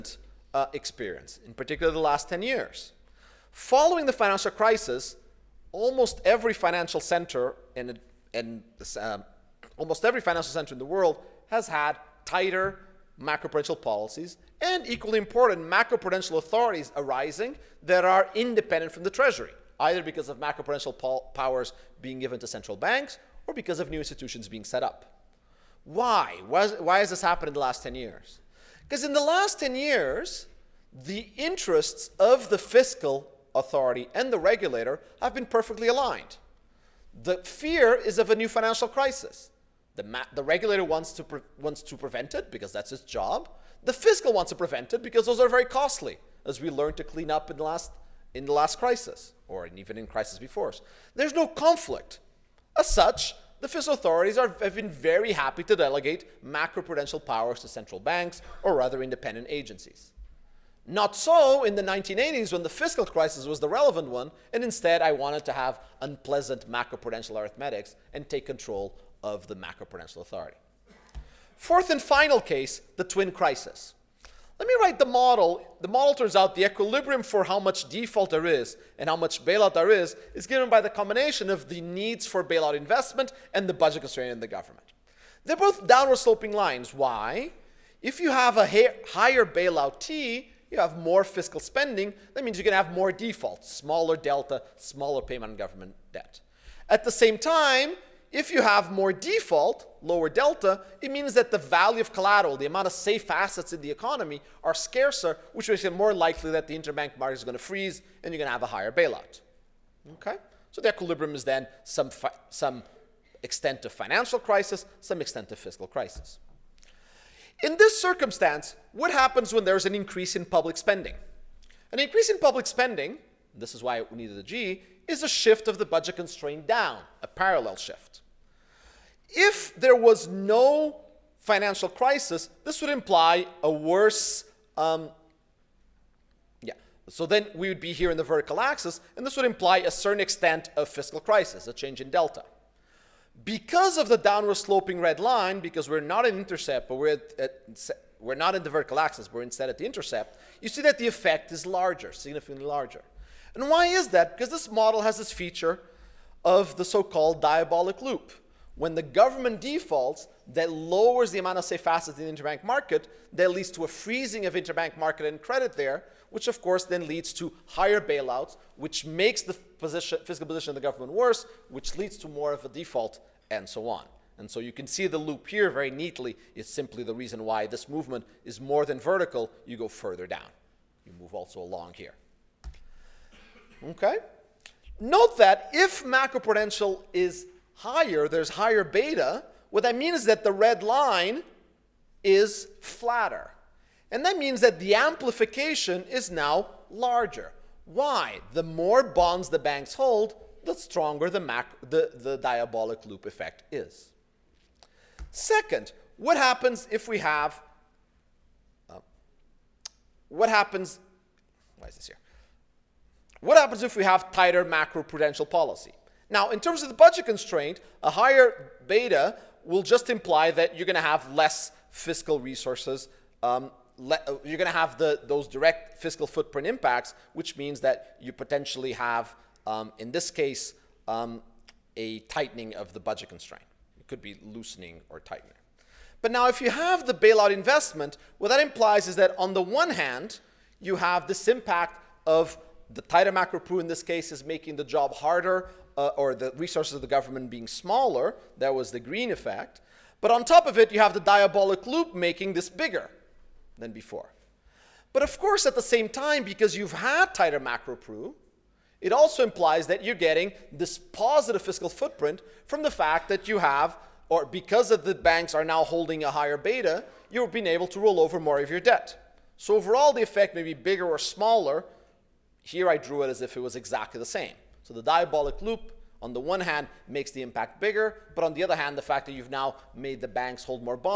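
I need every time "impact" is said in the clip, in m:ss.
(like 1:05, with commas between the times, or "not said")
3:46, 4:01, 4:37.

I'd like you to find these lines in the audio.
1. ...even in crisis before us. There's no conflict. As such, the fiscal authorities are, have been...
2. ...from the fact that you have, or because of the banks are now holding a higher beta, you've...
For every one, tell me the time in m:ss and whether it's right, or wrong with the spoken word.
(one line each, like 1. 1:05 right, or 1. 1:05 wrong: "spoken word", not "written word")
1. 0:49 right
2. 4:22 right.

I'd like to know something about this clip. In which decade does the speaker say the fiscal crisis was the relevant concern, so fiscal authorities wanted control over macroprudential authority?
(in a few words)
1980s.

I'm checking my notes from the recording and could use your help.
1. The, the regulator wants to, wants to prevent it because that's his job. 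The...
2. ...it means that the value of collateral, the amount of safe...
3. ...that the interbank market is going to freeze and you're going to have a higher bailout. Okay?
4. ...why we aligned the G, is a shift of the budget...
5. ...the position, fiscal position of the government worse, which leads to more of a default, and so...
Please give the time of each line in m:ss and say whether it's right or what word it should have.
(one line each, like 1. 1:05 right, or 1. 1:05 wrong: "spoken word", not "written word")
1. 0:39 right
2. 1:41 right
3. 1:46 right
4. 2:03 wrong: "needed", not "aligned"
5. 2:49 right.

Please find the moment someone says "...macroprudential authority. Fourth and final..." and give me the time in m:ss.
1:09.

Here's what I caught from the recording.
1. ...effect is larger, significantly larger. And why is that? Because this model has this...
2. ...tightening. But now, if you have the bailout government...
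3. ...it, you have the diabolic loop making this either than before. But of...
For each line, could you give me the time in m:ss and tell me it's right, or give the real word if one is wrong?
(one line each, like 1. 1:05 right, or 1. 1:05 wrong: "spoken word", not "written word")
1. 2:31 right
2. 3:55 wrong: "investment", not "government"
3. 4:10 wrong: "bigger", not "either".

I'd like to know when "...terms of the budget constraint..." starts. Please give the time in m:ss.
3:36.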